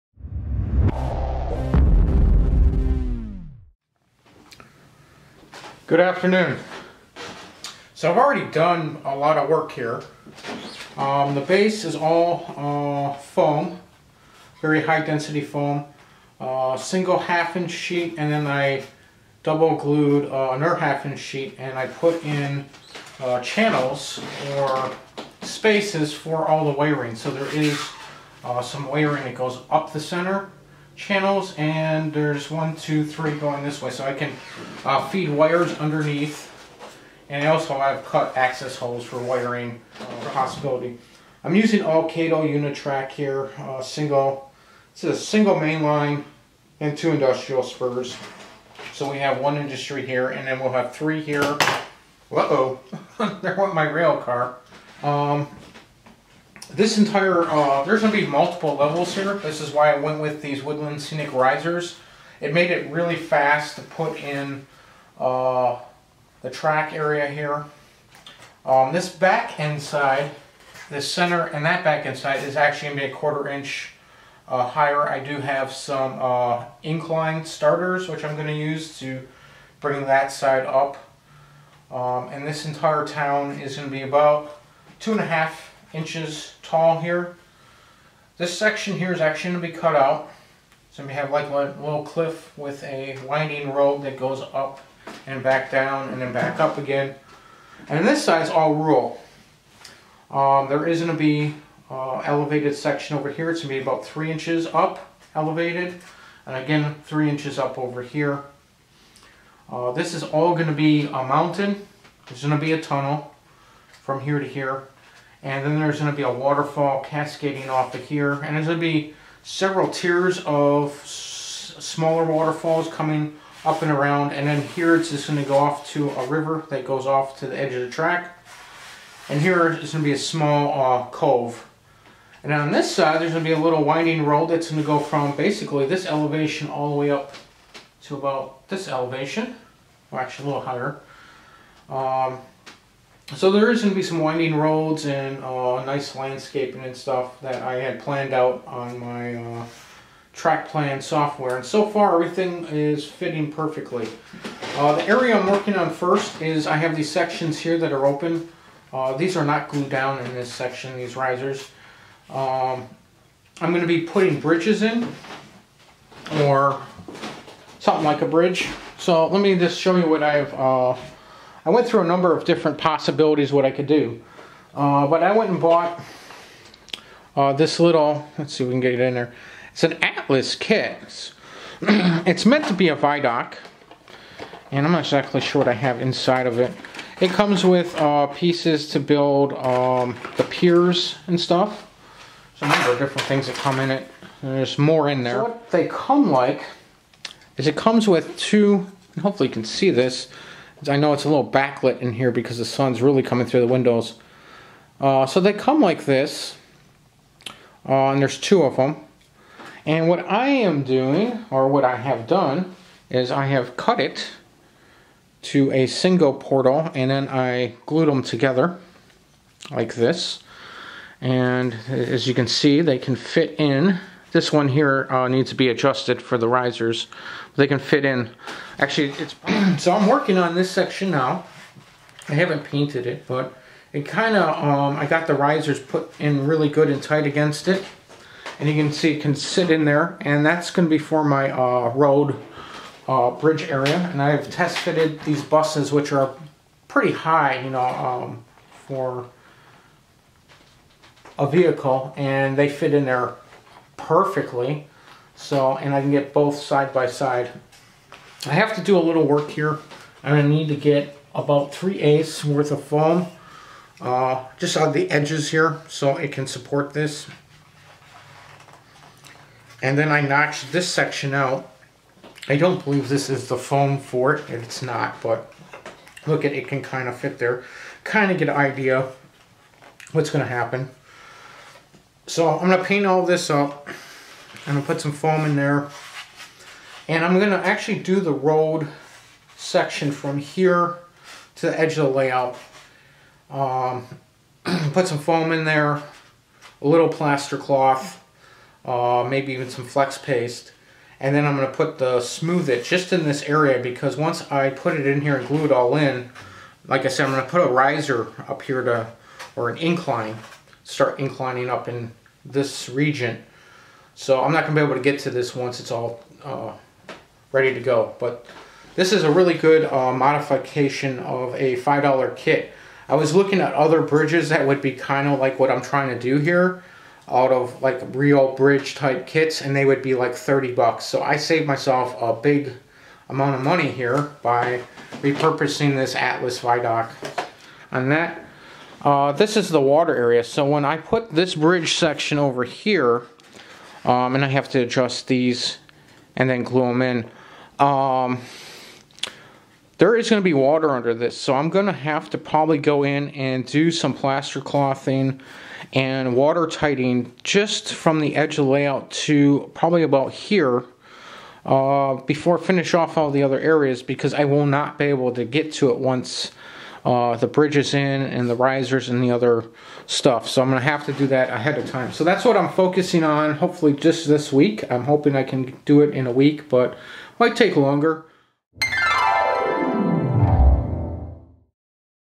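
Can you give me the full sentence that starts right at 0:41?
I'm using all Kato Unitrack here, uh, single, this is a single main line and two industrial spurs.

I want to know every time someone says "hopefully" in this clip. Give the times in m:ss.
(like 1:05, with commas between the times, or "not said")
3:19, 6:13.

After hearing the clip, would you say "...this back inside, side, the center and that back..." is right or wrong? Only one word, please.
right.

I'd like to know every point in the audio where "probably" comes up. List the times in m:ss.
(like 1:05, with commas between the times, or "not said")
5:52, 5:59.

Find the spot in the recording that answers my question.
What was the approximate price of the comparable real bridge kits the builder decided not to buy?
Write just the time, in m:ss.
5:30.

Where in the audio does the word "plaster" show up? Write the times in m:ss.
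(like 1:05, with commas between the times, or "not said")
4:57, 5:54.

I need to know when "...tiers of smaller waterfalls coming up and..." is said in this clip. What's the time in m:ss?
1:59.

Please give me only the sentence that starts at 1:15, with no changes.
I do have some uh, incline starters which I'm going to use to bring that side up.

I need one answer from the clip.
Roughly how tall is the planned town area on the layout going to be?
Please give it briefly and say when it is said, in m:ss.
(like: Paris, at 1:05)
2.5 inches, at 1:24.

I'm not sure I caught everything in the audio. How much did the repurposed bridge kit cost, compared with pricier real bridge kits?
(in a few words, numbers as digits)
$5.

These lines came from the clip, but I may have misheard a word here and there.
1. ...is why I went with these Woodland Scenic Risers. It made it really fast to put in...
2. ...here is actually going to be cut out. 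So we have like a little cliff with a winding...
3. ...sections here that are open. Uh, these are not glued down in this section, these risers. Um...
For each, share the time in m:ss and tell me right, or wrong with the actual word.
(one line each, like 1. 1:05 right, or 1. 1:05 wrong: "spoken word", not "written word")
1. 0:59 right
2. 1:28 right
3. 2:37 right.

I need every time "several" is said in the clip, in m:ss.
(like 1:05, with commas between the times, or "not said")
1:59.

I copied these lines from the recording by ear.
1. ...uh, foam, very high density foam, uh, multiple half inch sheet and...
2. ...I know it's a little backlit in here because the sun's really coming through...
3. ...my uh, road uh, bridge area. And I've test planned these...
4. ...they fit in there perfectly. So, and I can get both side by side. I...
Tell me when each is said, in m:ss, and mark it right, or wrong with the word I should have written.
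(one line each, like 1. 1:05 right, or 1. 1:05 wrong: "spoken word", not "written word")
1. 0:12 wrong: "single", not "multiple"
2. 3:20 right
3. 4:01 wrong: "fitted", not "planned"
4. 4:12 right.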